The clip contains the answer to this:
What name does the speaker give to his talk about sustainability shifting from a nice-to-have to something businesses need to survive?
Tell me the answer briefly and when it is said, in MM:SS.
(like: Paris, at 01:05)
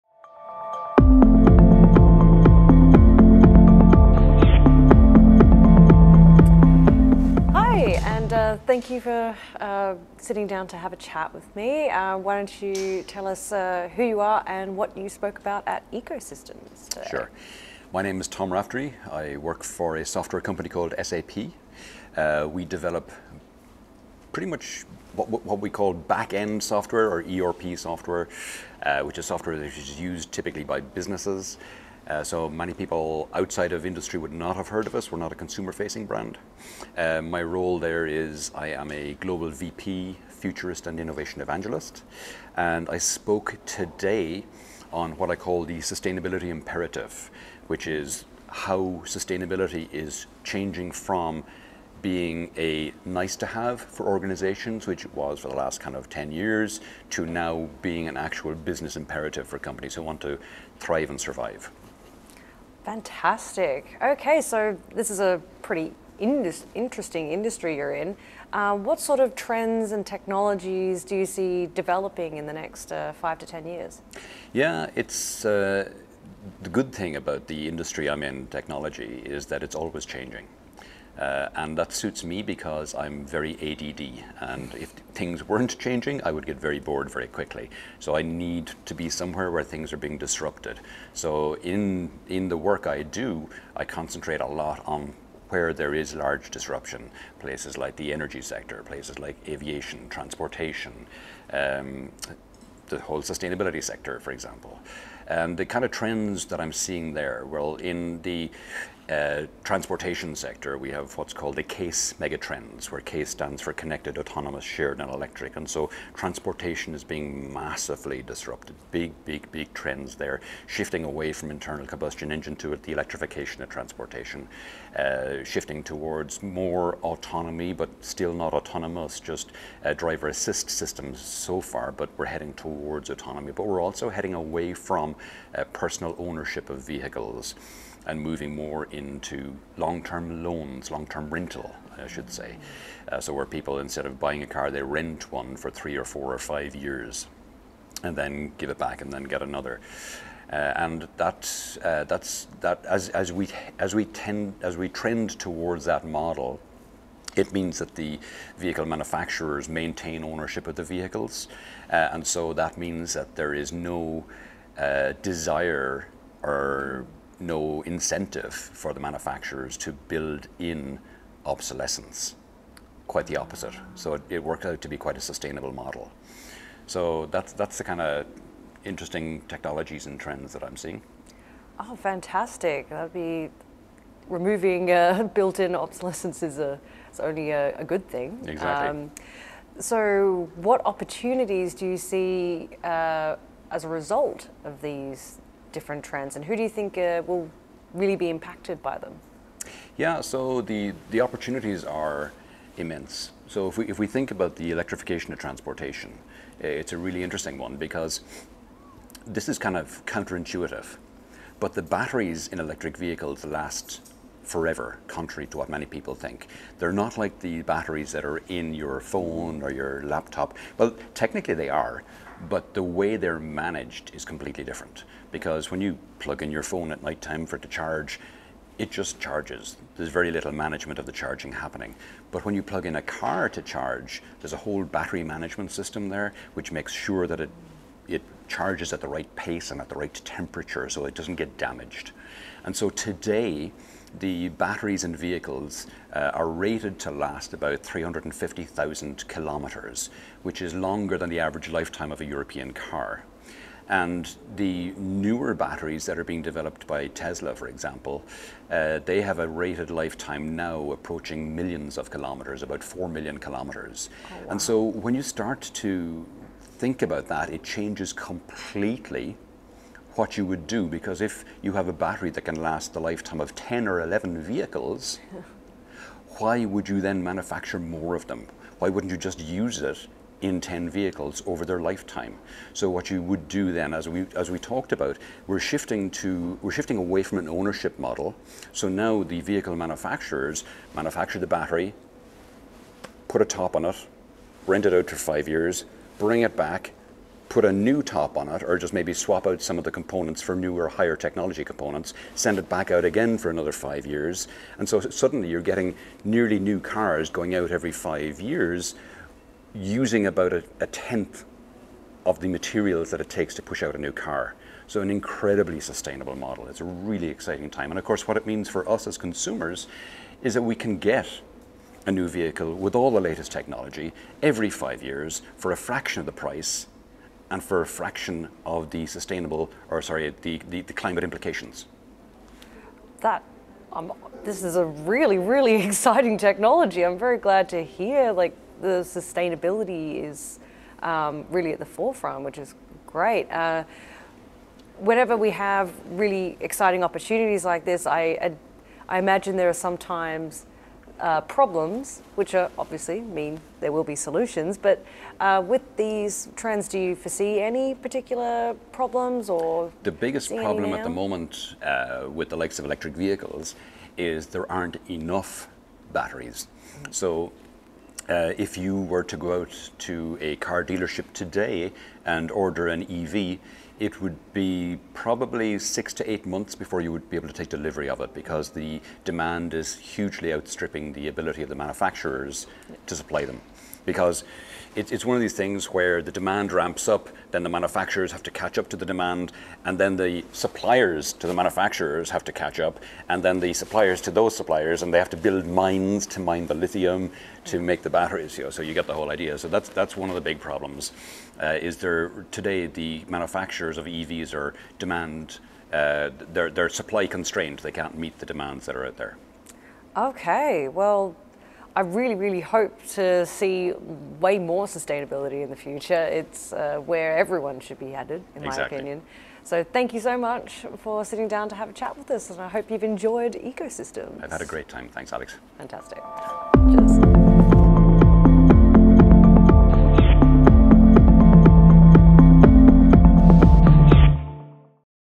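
the sustainability imperative, at 00:45.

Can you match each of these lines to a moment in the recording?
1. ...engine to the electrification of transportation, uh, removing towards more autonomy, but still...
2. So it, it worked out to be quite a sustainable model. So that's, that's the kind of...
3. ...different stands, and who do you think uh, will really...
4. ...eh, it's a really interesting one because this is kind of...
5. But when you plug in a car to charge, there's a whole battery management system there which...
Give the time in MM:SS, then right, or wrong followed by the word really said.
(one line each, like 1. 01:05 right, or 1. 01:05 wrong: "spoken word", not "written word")
1. 02:02 wrong: "shifting", not "removing"
2. 02:53 right
3. 03:15 wrong: "trends", not "stands"
4. 03:26 right
5. 03:52 right.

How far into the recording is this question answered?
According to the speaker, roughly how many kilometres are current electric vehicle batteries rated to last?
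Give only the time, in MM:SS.
04:07.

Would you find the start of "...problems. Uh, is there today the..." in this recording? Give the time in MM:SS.
06:40.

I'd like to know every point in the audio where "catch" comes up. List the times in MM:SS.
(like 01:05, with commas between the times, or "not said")
06:28, 06:32.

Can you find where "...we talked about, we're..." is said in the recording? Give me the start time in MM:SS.
04:44.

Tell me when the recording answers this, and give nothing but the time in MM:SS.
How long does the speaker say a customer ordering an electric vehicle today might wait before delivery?
06:15.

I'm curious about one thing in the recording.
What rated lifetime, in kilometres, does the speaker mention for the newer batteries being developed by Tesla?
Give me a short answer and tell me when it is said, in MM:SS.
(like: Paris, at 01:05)
4 million kilometers, at 04:22.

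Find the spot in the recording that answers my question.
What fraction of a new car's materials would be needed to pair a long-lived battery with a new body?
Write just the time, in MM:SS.
05:10.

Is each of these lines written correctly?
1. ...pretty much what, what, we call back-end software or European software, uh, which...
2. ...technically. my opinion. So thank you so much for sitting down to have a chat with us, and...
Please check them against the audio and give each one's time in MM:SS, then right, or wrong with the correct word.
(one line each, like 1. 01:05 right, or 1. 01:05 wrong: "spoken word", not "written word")
1. 00:24 wrong: "ERP", not "European"
2. 06:58 wrong: "exactly", not "technically".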